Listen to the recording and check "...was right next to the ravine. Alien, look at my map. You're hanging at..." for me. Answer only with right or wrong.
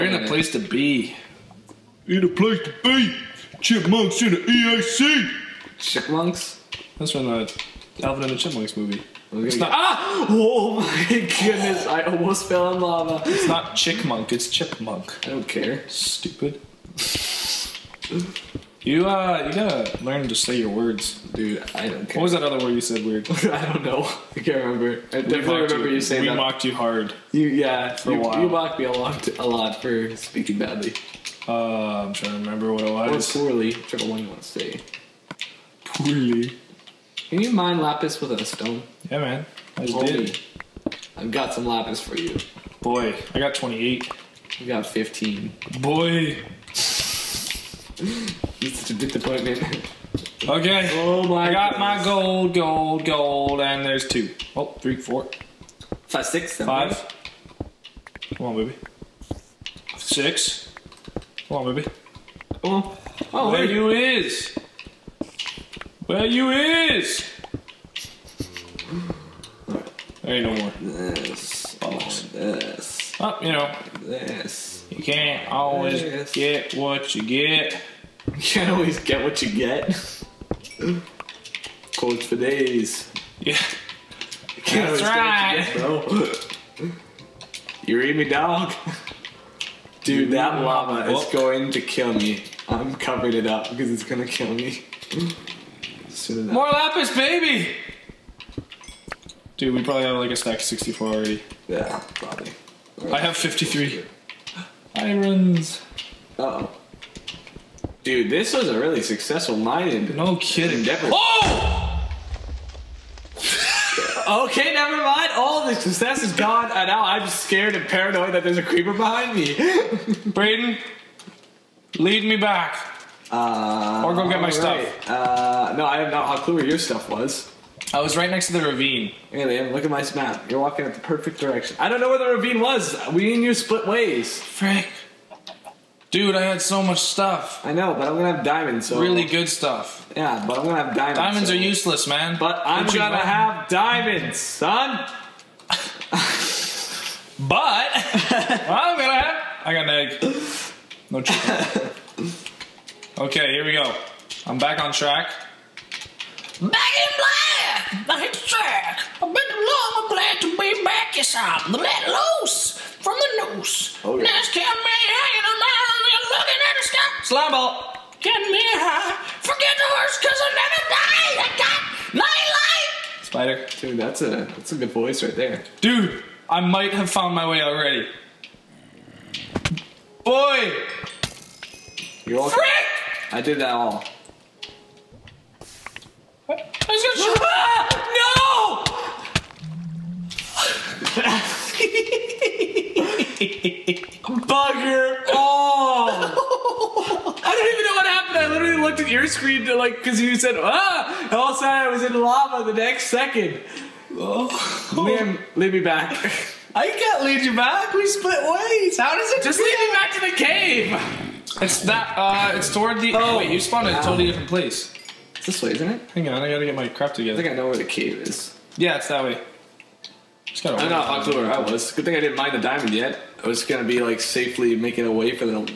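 wrong.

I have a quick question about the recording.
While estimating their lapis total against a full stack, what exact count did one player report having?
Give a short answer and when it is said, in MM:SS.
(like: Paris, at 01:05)
53, at 01:43.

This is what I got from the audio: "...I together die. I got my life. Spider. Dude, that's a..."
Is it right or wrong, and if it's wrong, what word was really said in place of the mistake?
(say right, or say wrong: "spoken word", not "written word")
wrong: "never", not "together".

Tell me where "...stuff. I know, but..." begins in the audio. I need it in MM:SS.
02:16.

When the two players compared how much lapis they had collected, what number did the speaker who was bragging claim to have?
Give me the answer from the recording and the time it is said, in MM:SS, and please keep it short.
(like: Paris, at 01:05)
28, at 00:43.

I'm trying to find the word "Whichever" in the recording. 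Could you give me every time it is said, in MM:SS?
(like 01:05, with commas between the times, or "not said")
00:33.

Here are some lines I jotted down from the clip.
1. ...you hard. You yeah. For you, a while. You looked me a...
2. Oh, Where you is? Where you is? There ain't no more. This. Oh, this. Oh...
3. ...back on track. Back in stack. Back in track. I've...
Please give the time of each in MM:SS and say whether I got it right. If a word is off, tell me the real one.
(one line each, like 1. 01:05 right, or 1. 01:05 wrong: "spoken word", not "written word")
1. 00:26 wrong: "mocked", not "looked"
2. 01:03 right
3. 02:34 wrong: "black", not "stack".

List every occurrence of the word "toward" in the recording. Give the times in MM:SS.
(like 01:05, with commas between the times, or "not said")
03:32.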